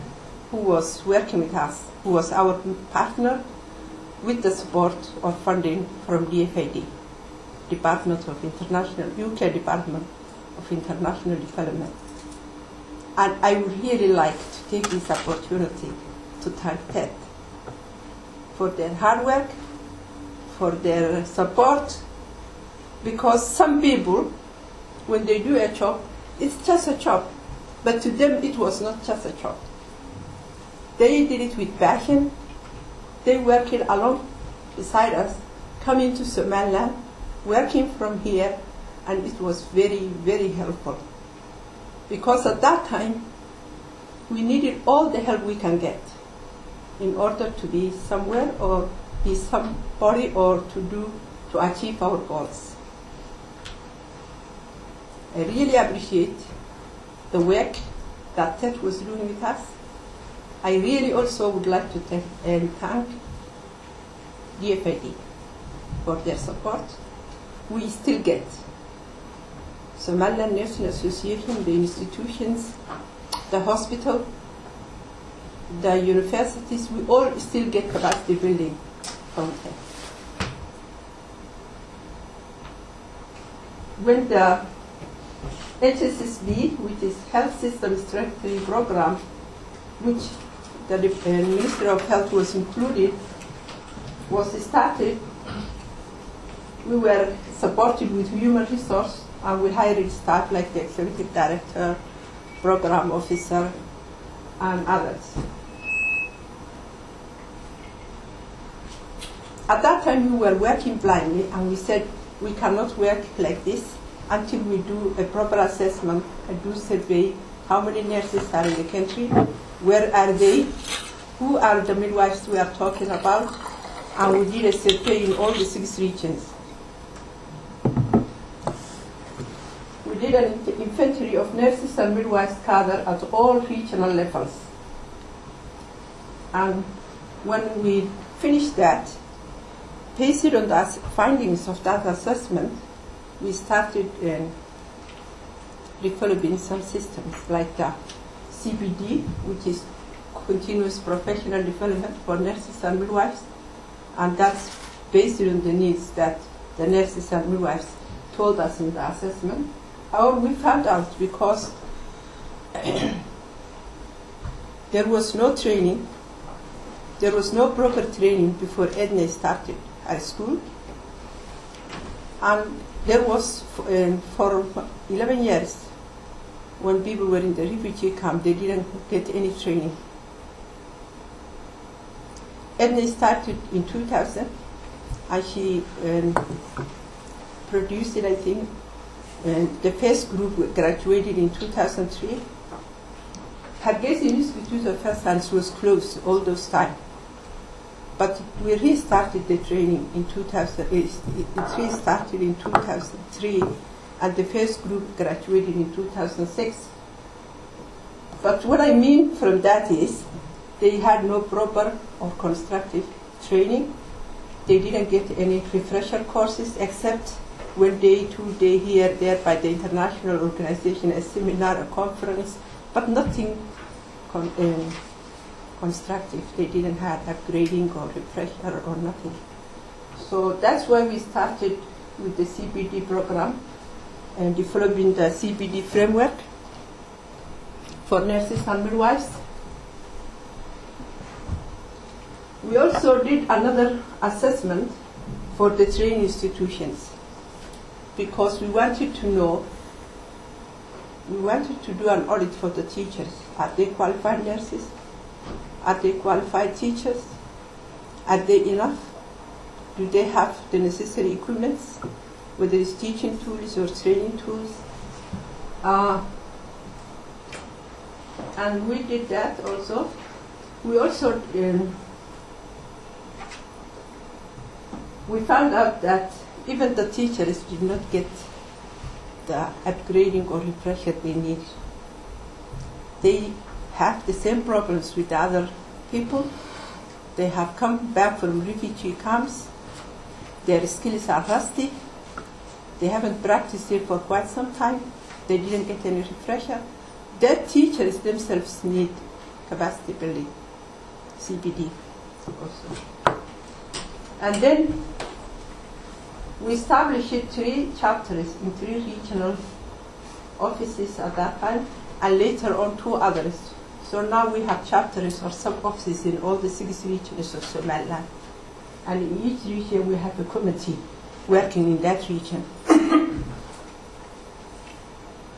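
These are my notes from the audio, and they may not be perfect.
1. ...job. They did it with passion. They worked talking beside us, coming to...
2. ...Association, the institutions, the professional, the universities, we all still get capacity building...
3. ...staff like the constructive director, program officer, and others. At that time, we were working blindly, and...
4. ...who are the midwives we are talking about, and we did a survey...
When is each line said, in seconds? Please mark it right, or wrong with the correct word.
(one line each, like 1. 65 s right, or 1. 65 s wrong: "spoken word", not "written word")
1. 29 s wrong: "along", not "talking"
2. 70 s wrong: "hospital", not "professional"
3. 100 s wrong: "executive", not "constructive"
4. 121 s right.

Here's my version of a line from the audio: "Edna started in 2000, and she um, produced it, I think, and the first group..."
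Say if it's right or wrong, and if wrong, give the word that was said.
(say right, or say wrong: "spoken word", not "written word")
right.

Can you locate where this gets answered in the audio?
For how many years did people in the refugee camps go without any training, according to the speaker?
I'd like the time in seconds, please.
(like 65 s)
175 s.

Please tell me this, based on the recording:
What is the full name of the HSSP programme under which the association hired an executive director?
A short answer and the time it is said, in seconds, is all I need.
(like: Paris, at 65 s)
Health System Strategy Program, at 87 s.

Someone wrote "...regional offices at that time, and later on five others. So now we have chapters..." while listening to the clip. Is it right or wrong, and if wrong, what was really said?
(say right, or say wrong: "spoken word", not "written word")
wrong: "two", not "five".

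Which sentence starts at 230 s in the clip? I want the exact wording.
So that's why we started with the CPD program and developing the CPD framework for nurses and midwives.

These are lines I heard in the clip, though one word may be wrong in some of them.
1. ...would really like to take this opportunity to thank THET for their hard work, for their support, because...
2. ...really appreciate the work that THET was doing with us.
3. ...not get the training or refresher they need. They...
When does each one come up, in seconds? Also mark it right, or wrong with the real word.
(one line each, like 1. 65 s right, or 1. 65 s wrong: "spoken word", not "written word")
1. 13 s right
2. 55 s right
3. 277 s wrong: "upgrading", not "training".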